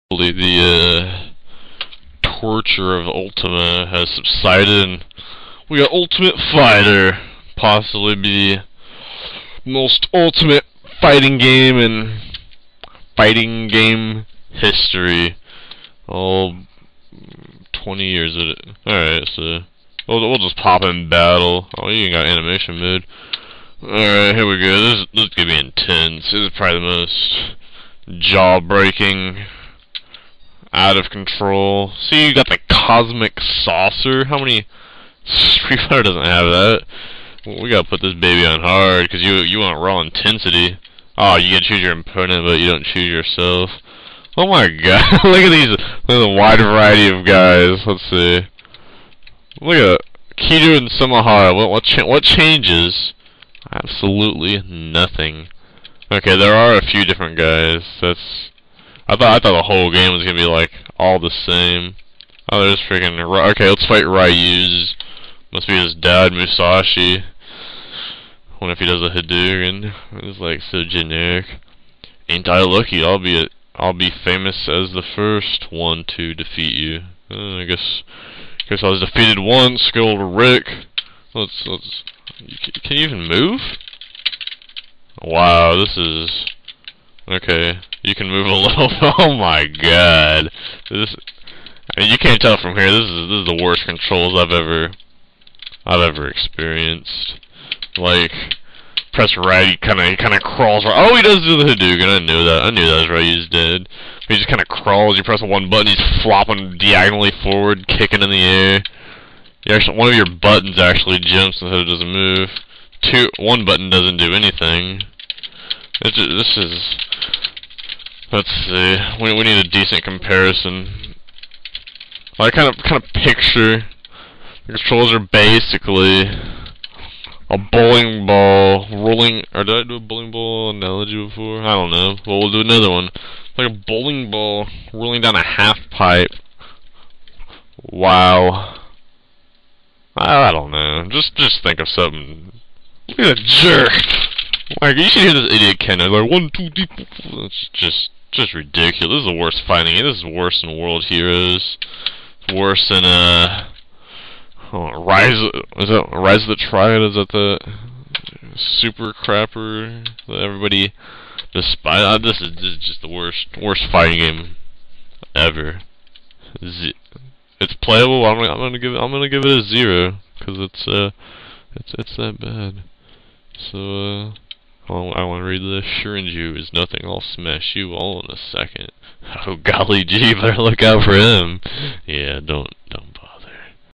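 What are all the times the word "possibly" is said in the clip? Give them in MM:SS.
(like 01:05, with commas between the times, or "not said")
00:07.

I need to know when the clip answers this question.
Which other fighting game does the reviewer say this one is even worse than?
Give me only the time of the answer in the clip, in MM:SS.
02:30.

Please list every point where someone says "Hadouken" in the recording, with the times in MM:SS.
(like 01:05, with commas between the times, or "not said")
01:09, 01:41.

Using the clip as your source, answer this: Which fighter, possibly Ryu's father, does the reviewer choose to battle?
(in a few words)
Musashi.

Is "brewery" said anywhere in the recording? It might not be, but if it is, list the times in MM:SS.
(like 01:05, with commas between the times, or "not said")
not said.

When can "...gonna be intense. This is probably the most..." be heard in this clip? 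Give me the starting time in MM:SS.
00:25.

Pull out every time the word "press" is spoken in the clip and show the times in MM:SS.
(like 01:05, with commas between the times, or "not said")
01:39, 01:45.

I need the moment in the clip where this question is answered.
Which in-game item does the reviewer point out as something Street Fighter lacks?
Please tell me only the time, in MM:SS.
00:32.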